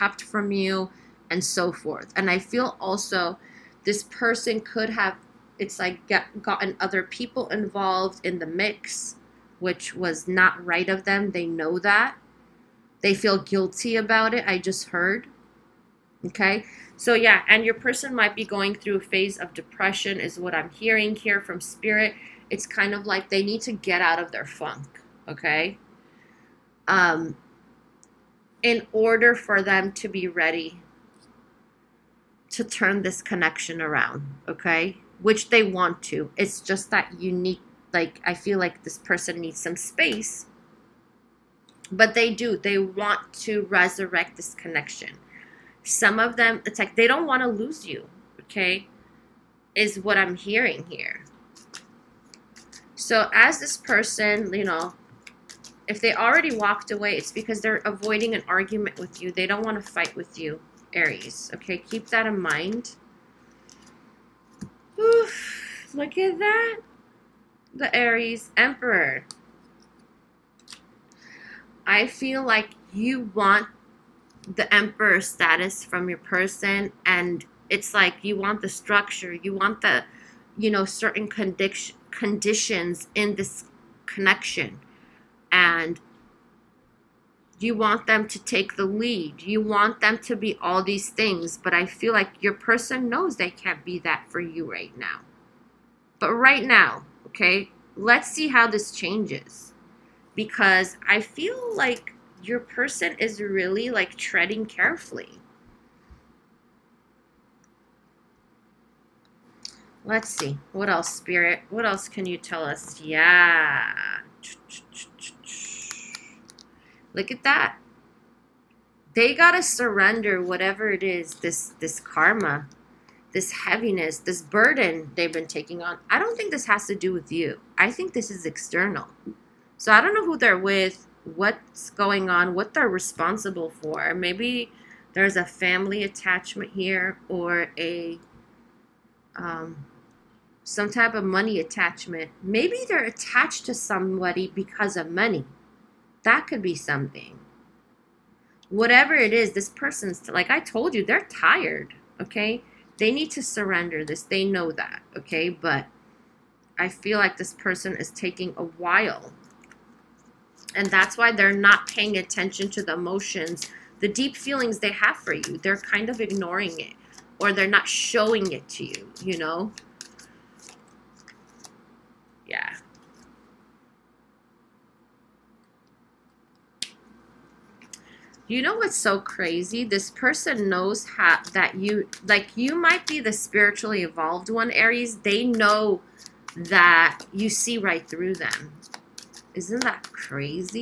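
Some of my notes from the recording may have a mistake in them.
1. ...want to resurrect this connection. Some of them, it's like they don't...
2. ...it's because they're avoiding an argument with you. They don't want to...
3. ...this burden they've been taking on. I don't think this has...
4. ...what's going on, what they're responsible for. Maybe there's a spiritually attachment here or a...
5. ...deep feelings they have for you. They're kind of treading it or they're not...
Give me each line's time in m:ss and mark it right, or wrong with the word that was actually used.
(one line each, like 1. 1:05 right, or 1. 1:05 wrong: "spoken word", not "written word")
1. 0:42 right
2. 0:57 right
3. 2:04 right
4. 2:11 wrong: "family", not "spiritually"
5. 2:44 wrong: "ignoring", not "treading".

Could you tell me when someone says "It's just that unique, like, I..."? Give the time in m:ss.
0:36.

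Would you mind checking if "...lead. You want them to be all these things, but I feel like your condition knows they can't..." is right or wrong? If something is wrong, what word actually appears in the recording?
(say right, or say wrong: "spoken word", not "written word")
wrong: "person", not "condition".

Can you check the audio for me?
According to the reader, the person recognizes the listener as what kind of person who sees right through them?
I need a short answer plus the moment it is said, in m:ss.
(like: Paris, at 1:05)
Spiritually evolved, at 3:03.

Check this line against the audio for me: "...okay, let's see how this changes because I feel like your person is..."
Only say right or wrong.
right.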